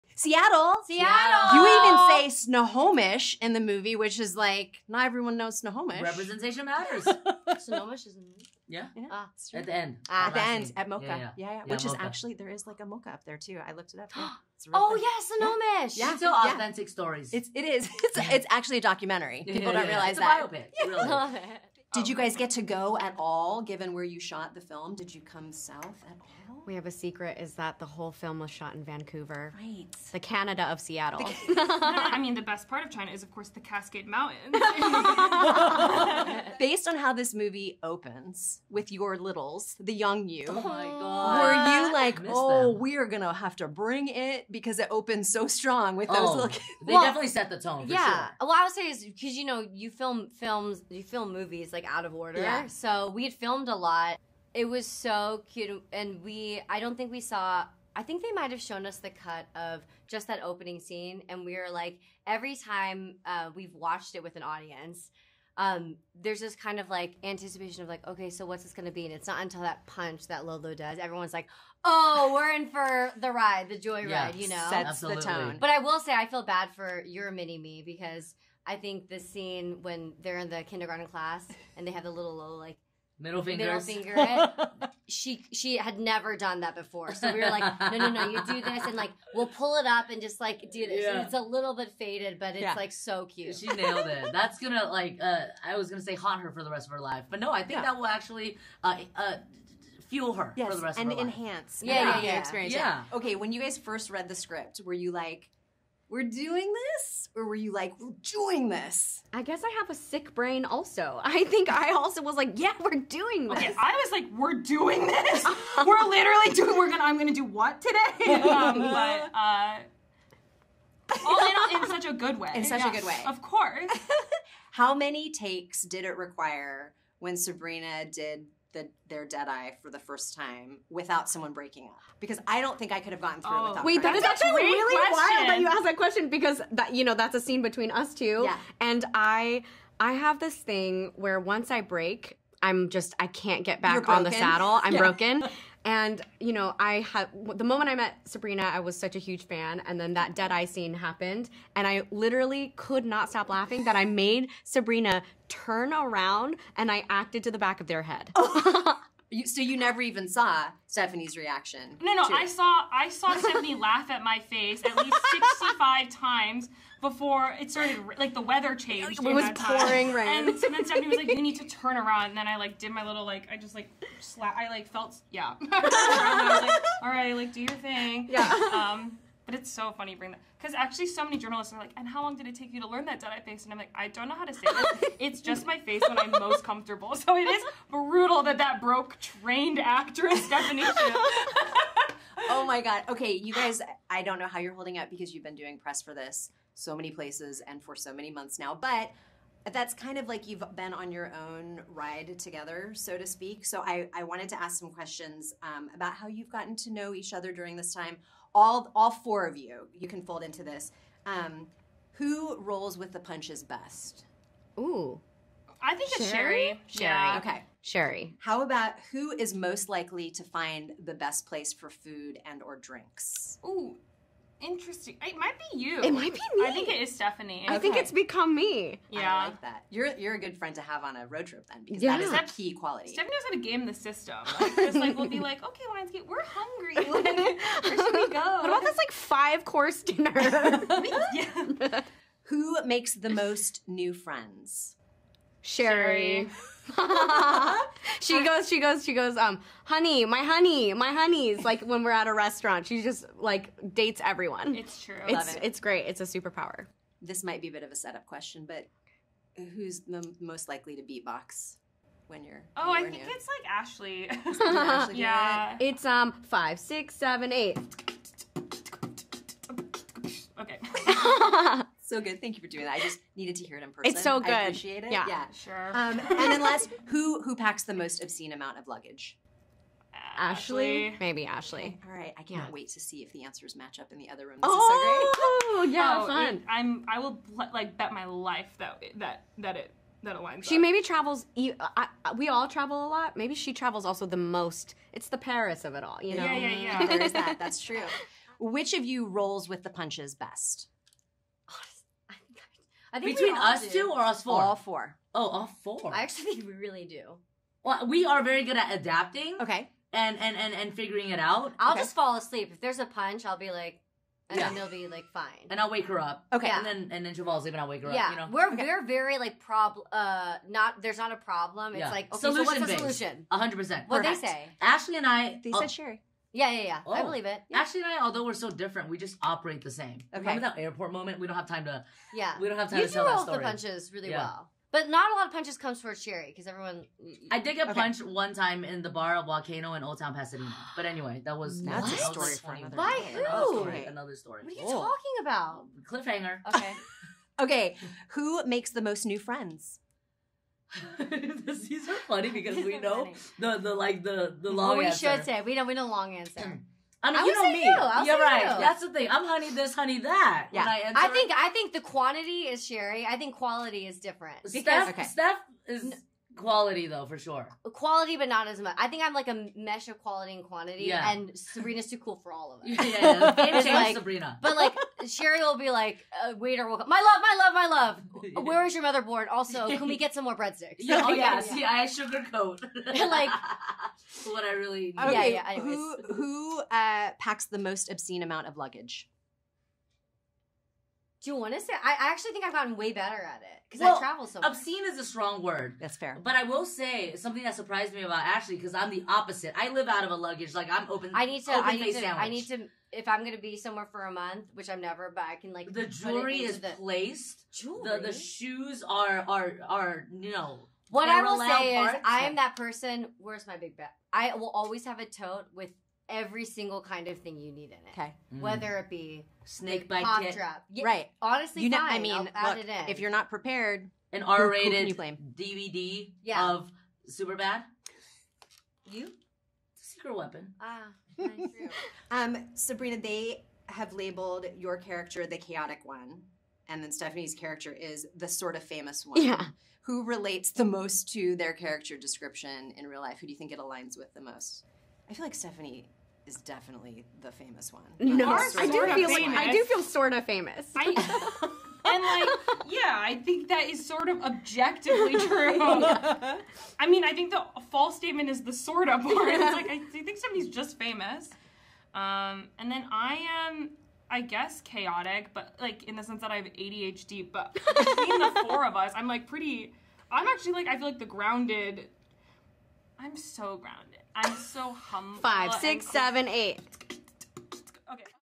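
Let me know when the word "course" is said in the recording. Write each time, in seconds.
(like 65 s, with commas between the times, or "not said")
33 s, 123 s, 239 s.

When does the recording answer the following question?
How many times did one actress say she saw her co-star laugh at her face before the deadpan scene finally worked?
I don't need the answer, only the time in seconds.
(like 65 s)
165 s.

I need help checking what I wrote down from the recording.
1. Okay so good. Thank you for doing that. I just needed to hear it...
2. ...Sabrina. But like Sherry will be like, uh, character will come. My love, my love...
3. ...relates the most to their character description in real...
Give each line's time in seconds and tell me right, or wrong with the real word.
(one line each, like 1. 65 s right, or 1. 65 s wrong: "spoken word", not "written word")
1. 270 s right
2. 374 s wrong: "waiter", not "character"
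3. 440 s right.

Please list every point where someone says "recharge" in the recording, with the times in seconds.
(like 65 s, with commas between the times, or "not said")
not said.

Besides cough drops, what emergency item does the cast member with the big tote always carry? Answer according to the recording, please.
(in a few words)
Snake bite.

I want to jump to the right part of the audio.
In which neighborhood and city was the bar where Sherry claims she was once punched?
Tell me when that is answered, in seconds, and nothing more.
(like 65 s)
340 s.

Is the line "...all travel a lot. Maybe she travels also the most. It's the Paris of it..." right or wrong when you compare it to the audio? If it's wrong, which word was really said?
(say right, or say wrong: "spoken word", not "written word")
right.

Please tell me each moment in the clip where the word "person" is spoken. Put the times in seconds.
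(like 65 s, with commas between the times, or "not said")
273 s, 412 s.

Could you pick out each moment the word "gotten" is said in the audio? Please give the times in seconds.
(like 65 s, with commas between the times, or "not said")
133 s, 206 s, 392 s.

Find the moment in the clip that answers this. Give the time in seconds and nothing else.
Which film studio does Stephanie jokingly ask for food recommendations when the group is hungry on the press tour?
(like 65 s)
235 s.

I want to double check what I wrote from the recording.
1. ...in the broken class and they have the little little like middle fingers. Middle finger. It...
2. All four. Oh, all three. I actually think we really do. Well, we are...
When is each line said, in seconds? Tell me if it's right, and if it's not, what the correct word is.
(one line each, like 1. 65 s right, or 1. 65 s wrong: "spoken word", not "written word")
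1. 80 s wrong: "kindergarten", not "broken"
2. 304 s wrong: "four", not "three".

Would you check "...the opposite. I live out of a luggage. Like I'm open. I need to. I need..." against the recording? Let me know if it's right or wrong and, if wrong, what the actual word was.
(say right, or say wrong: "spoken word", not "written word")
right.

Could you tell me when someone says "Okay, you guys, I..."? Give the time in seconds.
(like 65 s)
193 s.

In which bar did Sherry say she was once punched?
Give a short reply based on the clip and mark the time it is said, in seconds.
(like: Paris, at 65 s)
Volcano, at 339 s.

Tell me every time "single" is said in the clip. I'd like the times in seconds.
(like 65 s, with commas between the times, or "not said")
416 s.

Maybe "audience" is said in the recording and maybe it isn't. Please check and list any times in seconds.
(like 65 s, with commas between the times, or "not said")
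64 s.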